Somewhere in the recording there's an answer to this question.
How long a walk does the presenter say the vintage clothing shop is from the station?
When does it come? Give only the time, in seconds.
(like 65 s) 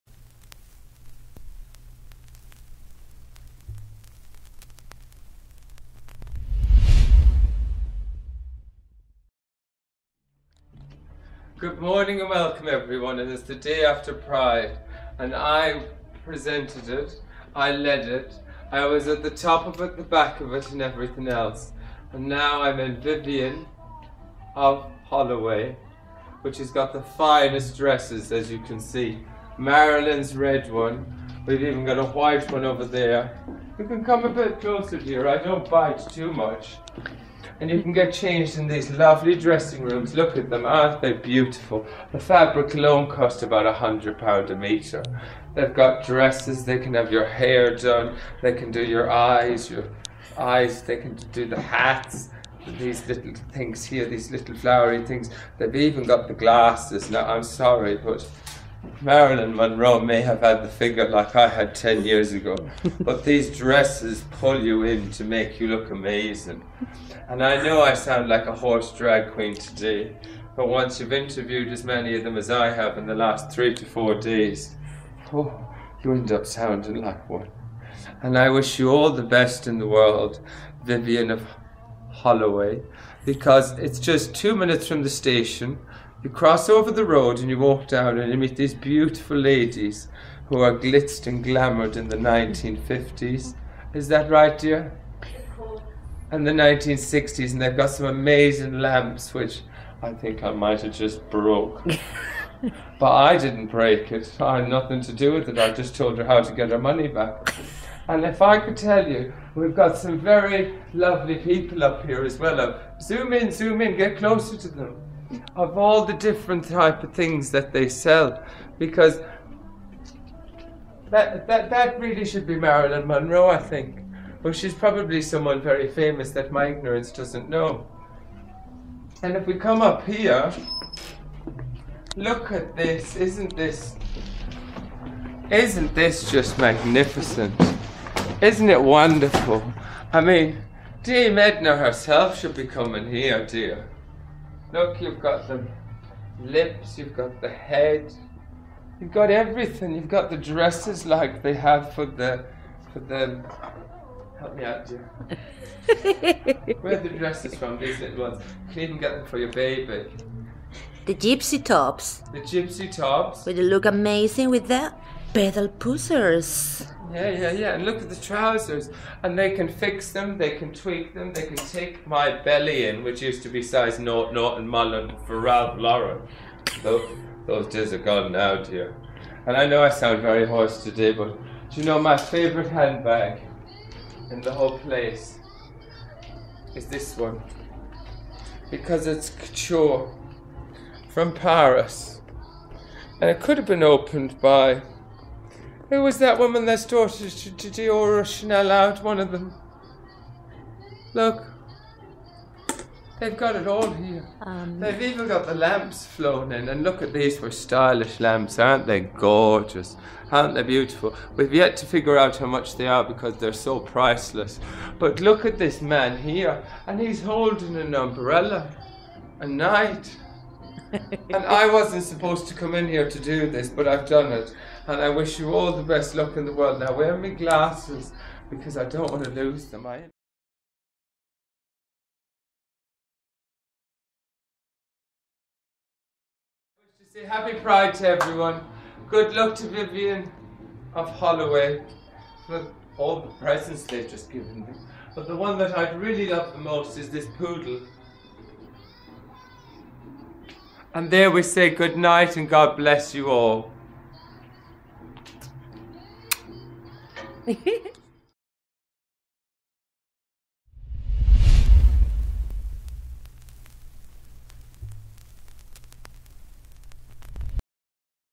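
84 s.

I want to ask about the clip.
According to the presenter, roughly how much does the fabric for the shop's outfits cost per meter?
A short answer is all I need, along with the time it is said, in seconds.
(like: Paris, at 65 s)
£100, at 43 s.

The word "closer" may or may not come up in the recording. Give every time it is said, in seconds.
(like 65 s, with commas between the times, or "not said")
34 s, 114 s.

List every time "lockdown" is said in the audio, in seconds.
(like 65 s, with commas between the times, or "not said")
not said.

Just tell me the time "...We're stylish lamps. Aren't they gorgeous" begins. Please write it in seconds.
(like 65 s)
207 s.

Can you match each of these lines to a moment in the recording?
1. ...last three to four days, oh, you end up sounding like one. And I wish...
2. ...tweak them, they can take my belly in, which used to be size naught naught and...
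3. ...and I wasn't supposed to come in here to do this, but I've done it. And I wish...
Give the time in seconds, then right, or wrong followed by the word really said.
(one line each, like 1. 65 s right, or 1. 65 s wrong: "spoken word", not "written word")
1. 73 s right
2. 170 s right
3. 220 s right.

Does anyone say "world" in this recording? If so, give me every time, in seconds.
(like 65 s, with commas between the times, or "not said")
79 s, 226 s.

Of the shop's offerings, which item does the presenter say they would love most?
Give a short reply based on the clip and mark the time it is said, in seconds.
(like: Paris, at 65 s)
poodle, at 247 s.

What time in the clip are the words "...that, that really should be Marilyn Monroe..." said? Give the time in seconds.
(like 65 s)
121 s.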